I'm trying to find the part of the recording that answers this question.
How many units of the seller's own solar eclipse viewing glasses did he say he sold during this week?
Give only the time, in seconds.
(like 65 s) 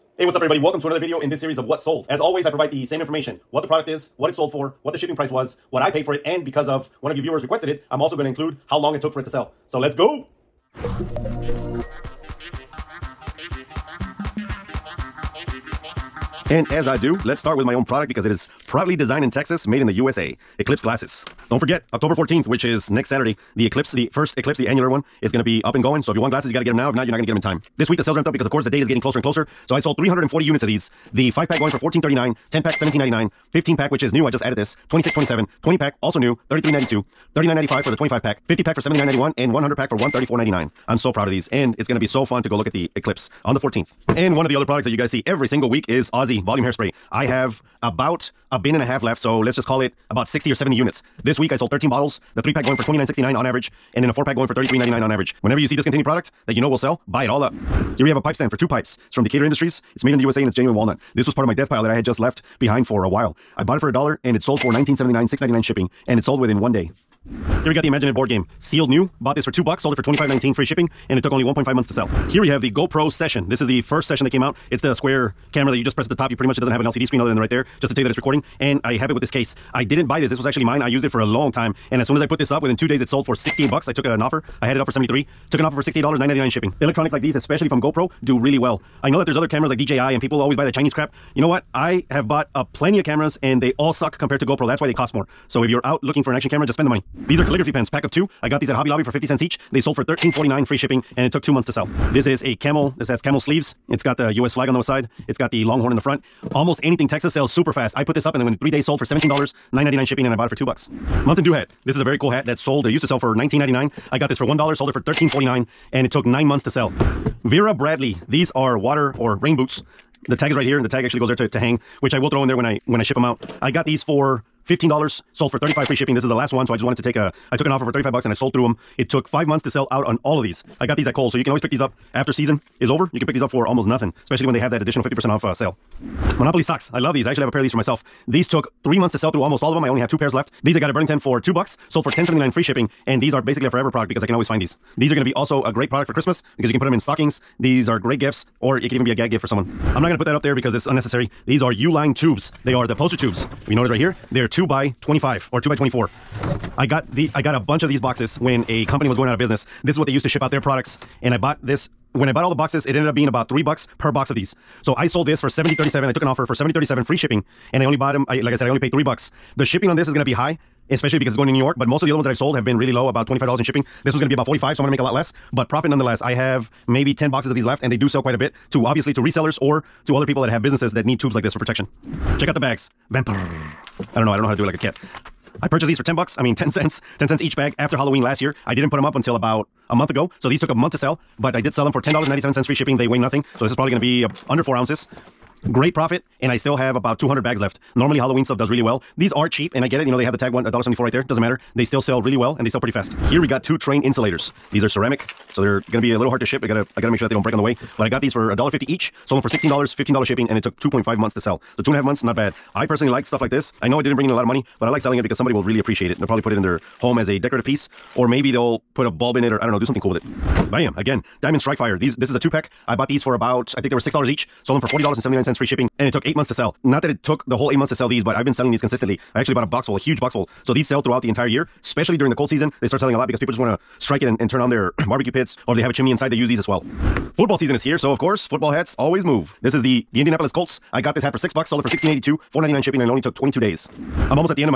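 29 s.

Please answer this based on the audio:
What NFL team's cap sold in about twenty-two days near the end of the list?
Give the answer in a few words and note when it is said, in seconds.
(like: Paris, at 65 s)
Indianapolis Colts, at 240 s.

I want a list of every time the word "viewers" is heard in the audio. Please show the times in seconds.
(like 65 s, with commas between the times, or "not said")
7 s.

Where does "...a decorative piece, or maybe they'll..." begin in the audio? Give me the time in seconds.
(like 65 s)
217 s.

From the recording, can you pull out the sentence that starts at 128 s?
It took five months to sell out on all of these.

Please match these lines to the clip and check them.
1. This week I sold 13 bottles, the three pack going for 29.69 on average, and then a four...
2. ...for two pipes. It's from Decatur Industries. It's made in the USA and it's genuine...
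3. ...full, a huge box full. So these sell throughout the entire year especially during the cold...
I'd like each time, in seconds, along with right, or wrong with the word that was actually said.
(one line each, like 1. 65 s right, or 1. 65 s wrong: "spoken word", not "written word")
1. 51 s right
2. 58 s right
3. 229 s right.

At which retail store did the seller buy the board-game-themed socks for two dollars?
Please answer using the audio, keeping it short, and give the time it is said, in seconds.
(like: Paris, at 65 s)
Burlington, at 140 s.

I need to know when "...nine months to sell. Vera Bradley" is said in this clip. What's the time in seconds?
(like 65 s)
116 s.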